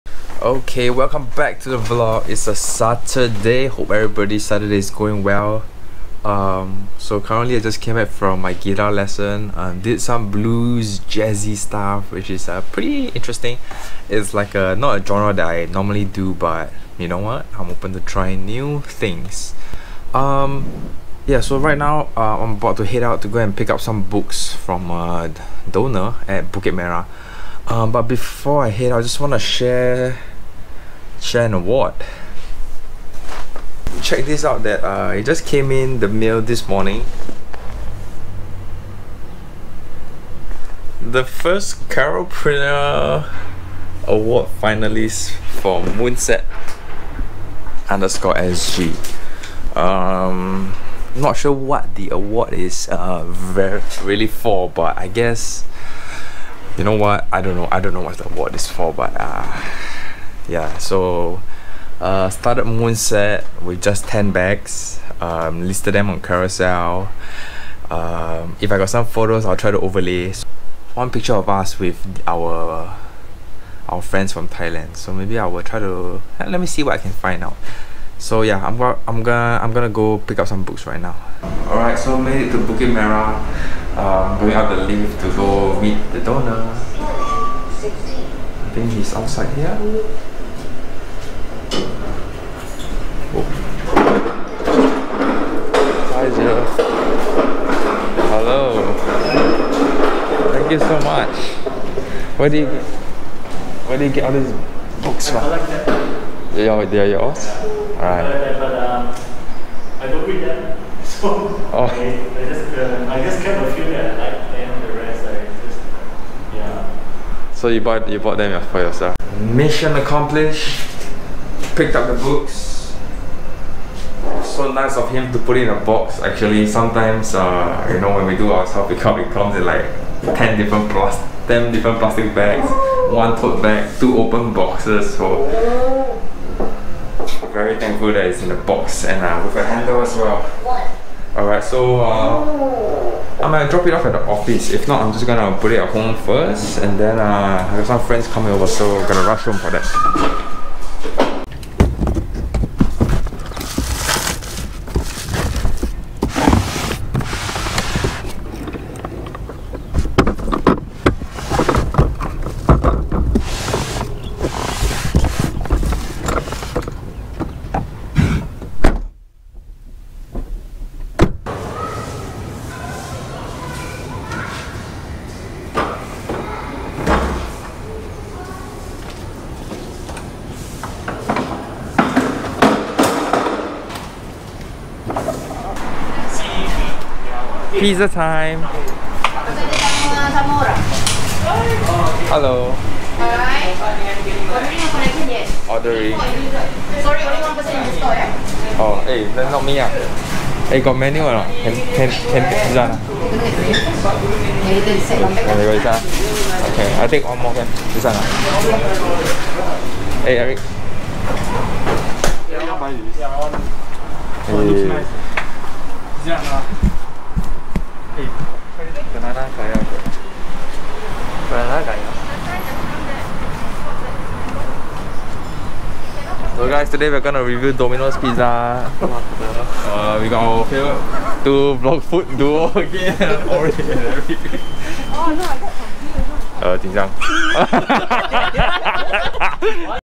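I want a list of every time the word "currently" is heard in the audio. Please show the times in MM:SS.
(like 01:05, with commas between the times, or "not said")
00:07.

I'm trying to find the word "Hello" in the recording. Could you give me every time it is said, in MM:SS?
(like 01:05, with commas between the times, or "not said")
01:38, 03:12.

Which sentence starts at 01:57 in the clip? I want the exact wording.
So you bought, you bought them for yourself?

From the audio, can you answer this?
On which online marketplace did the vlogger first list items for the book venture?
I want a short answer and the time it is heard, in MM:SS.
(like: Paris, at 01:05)
Carousell, at 01:06.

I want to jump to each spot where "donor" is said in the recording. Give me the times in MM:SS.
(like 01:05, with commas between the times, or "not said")
00:25, 01:26.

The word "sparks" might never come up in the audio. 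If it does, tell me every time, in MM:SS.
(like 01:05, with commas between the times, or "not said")
not said.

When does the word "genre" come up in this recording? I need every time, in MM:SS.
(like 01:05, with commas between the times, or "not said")
00:15.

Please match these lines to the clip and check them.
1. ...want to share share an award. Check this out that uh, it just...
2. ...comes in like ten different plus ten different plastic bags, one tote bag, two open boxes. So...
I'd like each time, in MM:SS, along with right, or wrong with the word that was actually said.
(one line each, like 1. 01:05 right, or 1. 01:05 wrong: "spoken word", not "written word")
1. 00:29 right
2. 02:09 right.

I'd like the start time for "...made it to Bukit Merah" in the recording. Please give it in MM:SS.
01:22.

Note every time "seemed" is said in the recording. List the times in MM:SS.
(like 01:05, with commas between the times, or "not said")
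not said.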